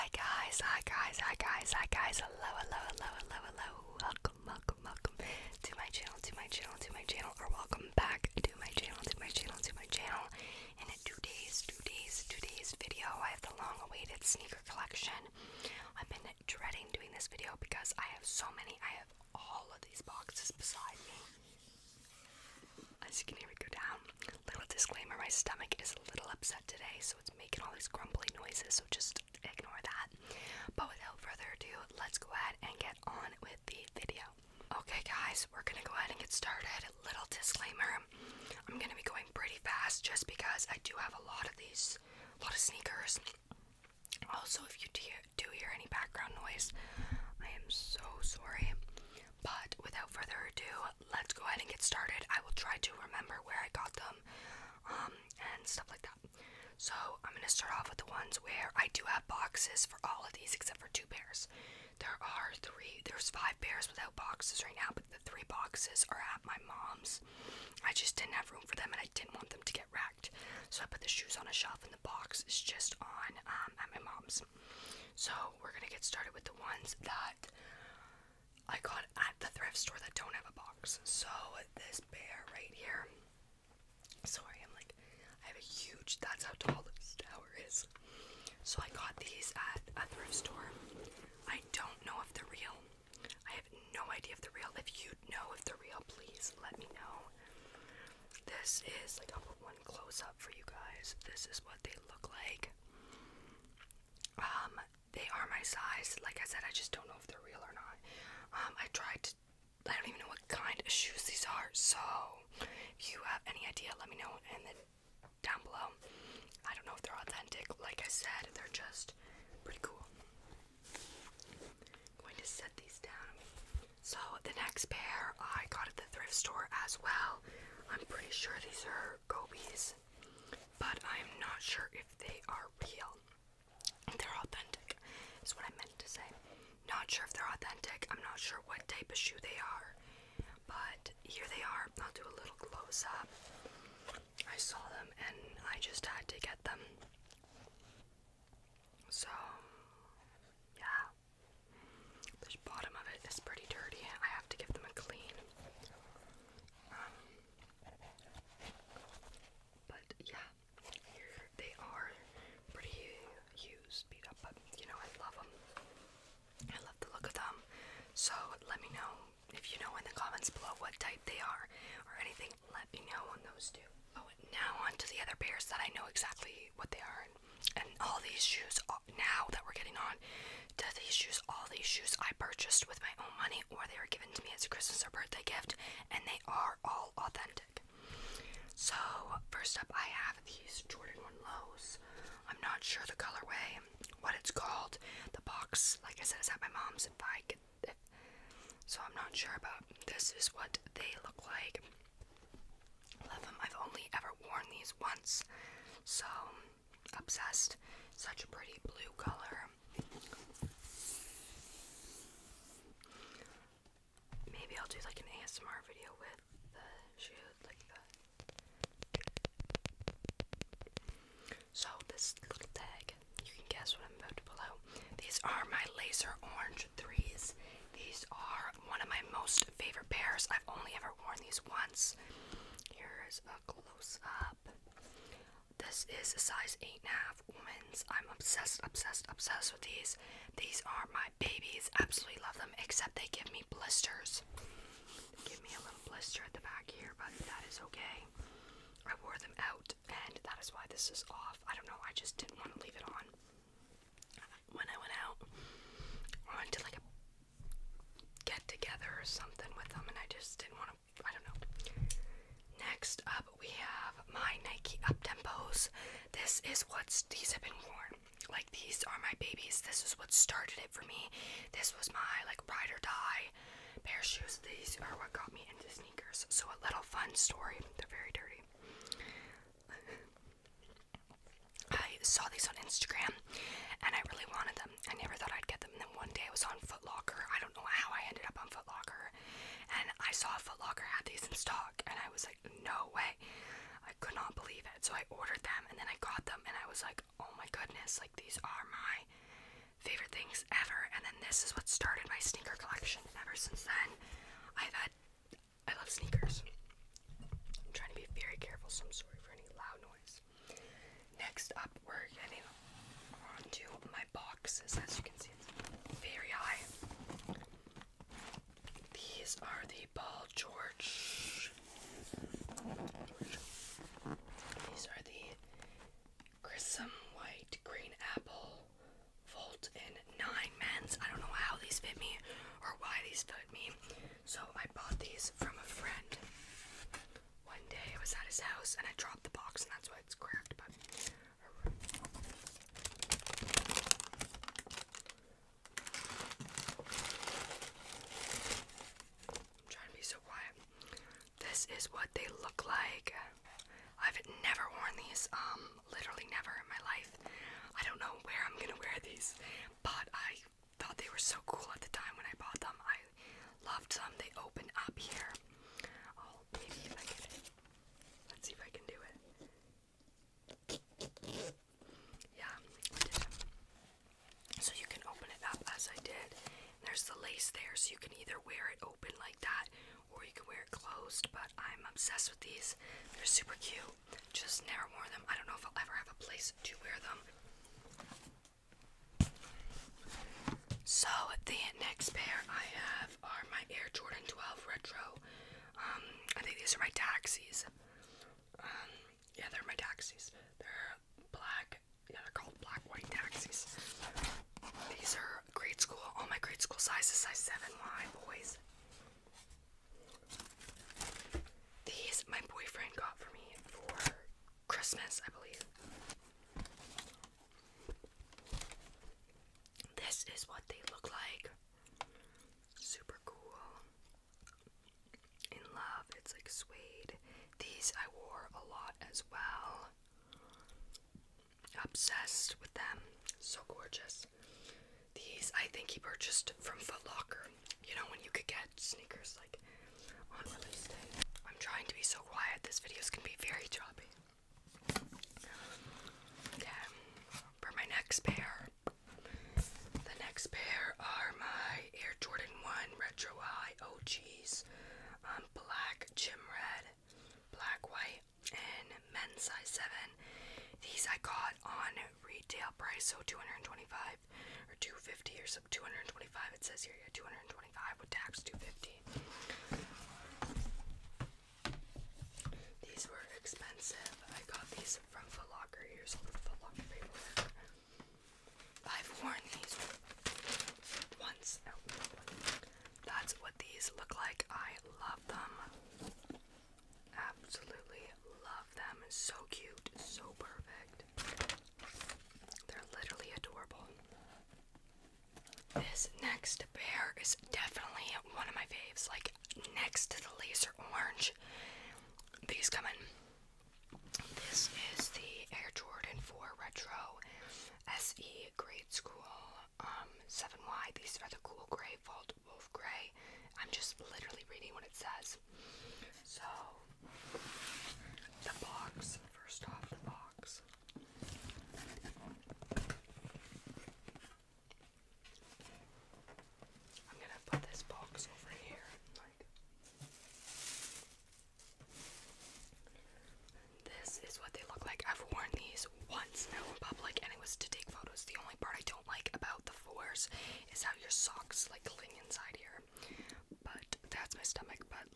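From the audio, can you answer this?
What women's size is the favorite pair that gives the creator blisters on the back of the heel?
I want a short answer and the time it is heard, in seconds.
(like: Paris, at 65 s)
8.5, at 236 s.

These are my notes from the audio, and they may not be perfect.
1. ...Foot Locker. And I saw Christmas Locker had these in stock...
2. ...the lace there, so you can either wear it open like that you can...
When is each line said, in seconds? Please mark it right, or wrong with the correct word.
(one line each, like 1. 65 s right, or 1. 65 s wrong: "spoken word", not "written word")
1. 288 s wrong: "Foot", not "Christmas"
2. 377 s right.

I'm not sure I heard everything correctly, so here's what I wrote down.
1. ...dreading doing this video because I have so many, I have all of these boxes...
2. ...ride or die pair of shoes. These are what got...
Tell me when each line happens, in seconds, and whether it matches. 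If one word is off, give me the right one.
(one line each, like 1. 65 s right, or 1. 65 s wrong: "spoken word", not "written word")
1. 16 s right
2. 272 s right.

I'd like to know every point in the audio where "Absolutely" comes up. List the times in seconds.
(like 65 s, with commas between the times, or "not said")
241 s.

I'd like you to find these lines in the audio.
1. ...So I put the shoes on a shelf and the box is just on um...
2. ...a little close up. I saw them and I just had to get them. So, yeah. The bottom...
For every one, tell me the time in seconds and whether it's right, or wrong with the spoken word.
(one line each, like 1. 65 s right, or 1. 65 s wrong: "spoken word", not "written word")
1. 70 s right
2. 142 s right.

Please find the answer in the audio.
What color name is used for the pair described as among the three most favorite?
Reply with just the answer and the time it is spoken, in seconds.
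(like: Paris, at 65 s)
Laser orange, at 226 s.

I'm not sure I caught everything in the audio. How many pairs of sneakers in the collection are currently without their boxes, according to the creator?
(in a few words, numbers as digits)
5.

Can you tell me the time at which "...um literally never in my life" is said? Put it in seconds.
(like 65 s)
355 s.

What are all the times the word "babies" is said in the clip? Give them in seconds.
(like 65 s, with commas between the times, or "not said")
241 s, 269 s.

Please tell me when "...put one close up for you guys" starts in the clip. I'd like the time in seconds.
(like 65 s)
99 s.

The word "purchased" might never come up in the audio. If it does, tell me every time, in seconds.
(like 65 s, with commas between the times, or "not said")
182 s, 436 s.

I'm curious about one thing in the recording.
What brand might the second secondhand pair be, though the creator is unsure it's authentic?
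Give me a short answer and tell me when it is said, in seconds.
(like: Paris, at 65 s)
Gobies, at 129 s.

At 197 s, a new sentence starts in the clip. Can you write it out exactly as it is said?
If I could, if so I'm not sure about this is what they look like.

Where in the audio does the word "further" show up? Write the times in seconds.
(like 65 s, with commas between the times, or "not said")
31 s, 50 s.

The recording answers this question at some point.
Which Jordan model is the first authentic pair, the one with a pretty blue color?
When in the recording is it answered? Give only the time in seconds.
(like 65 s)
190 s.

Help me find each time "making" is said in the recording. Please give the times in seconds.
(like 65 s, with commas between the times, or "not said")
27 s.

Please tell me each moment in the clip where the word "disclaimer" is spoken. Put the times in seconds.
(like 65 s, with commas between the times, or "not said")
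24 s, 37 s.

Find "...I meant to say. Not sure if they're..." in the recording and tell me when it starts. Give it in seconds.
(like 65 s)
135 s.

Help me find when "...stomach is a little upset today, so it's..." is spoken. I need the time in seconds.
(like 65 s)
25 s.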